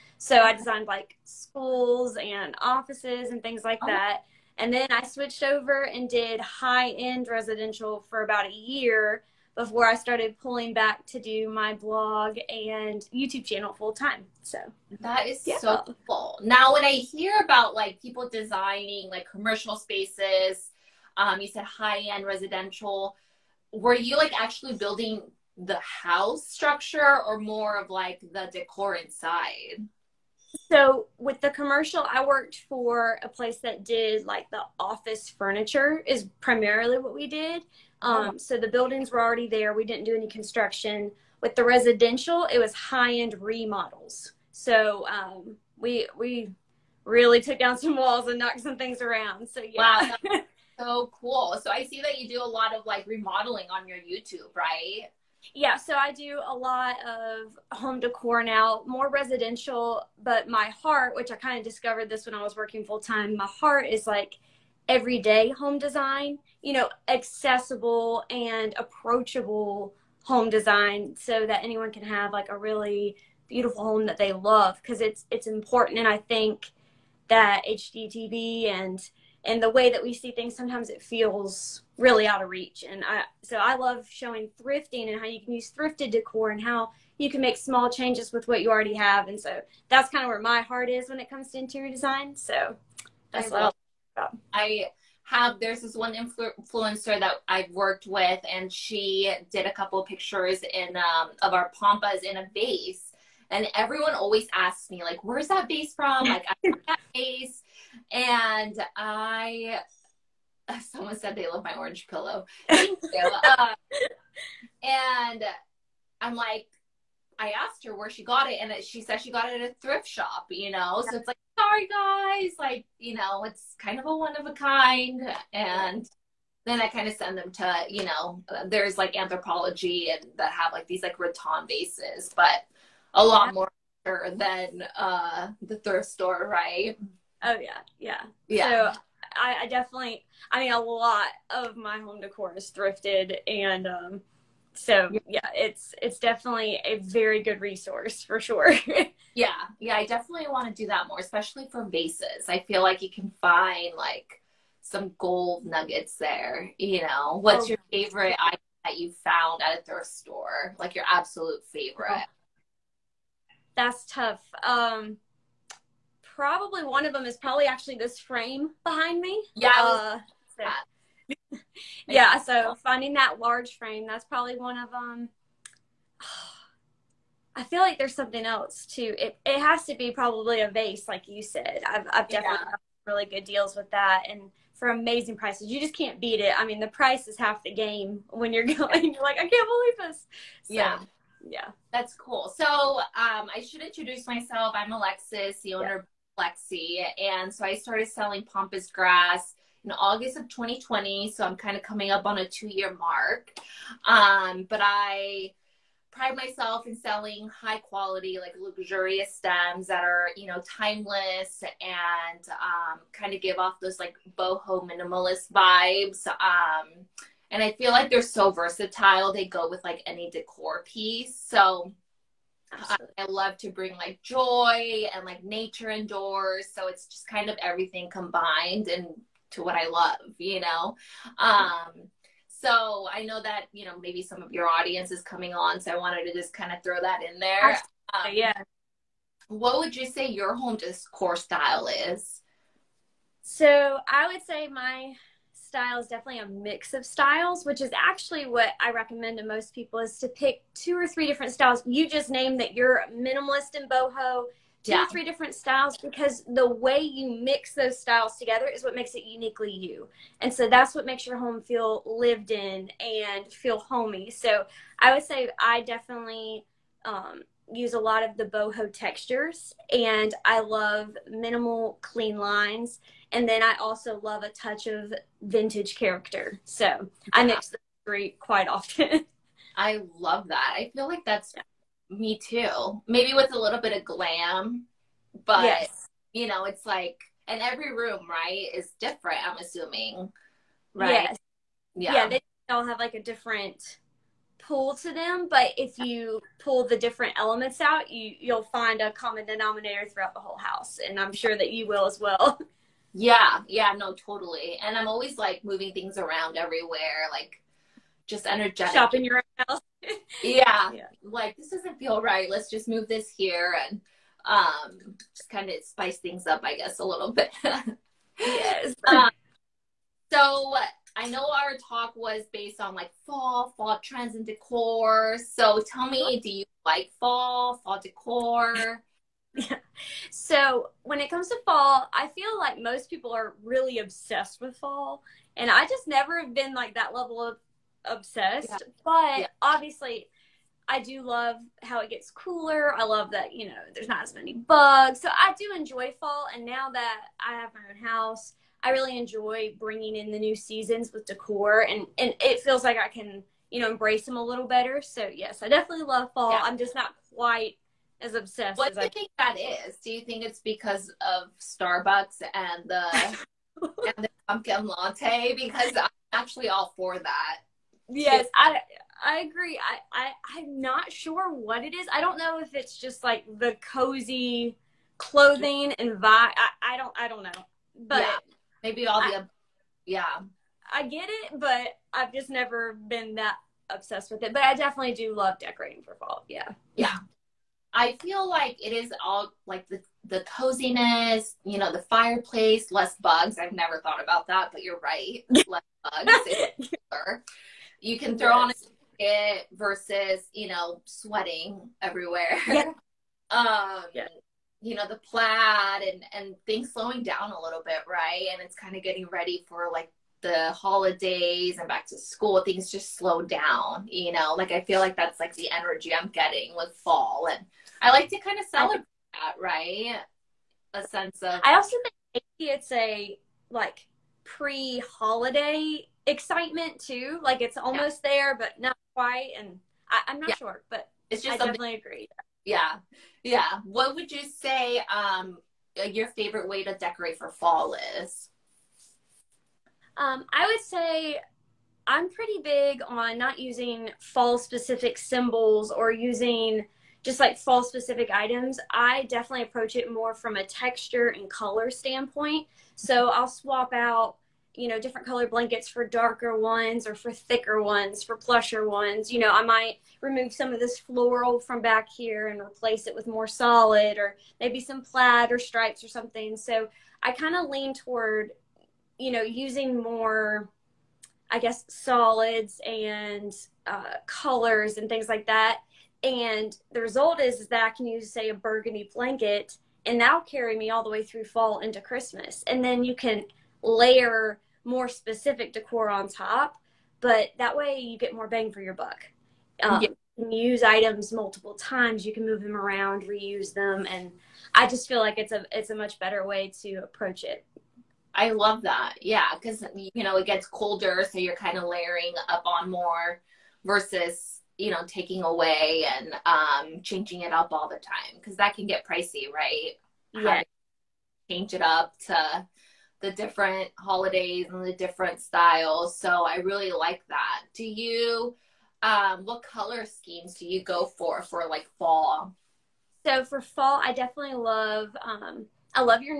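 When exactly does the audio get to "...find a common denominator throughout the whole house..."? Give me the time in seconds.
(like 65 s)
298 s.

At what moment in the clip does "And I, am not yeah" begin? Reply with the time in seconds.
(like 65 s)
429 s.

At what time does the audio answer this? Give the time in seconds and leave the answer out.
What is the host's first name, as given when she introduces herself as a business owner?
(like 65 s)
194 s.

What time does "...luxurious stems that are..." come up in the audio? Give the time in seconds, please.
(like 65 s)
208 s.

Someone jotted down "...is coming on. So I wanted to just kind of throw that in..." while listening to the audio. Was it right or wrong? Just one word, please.
right.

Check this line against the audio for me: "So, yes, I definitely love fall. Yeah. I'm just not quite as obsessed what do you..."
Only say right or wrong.
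right.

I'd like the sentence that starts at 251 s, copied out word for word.
You just named that you're minimalist and boho two yeah.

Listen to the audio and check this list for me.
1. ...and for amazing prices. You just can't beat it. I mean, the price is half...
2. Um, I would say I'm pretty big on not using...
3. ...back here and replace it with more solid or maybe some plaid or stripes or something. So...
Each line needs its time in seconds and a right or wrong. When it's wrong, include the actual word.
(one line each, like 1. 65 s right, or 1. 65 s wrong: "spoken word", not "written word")
1. 184 s right
2. 440 s right
3. 461 s right.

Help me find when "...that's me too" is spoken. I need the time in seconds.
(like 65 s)
281 s.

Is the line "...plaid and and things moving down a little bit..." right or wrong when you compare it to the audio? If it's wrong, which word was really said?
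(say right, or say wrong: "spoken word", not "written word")
wrong: "slowing", not "moving".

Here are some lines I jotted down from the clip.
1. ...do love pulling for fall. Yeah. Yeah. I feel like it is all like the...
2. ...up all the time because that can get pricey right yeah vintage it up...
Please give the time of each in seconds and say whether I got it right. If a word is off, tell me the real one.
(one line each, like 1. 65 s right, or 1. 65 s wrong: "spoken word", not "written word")
1. 385 s wrong: "decorating", not "pulling"
2. 507 s wrong: "change", not "vintage".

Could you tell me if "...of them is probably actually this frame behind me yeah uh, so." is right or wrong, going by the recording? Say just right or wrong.
right.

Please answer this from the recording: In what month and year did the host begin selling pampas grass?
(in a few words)
August 2020.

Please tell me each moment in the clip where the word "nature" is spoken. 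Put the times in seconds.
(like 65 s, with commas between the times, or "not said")
225 s.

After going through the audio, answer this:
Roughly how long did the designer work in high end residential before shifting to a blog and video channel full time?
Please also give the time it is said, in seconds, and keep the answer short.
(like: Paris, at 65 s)
about a year, at 8 s.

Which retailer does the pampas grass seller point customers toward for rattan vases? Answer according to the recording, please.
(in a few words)
Anthropologie.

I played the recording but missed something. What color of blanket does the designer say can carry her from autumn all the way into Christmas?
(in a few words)
burgundy.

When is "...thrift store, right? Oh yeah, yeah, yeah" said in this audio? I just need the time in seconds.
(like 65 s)
135 s.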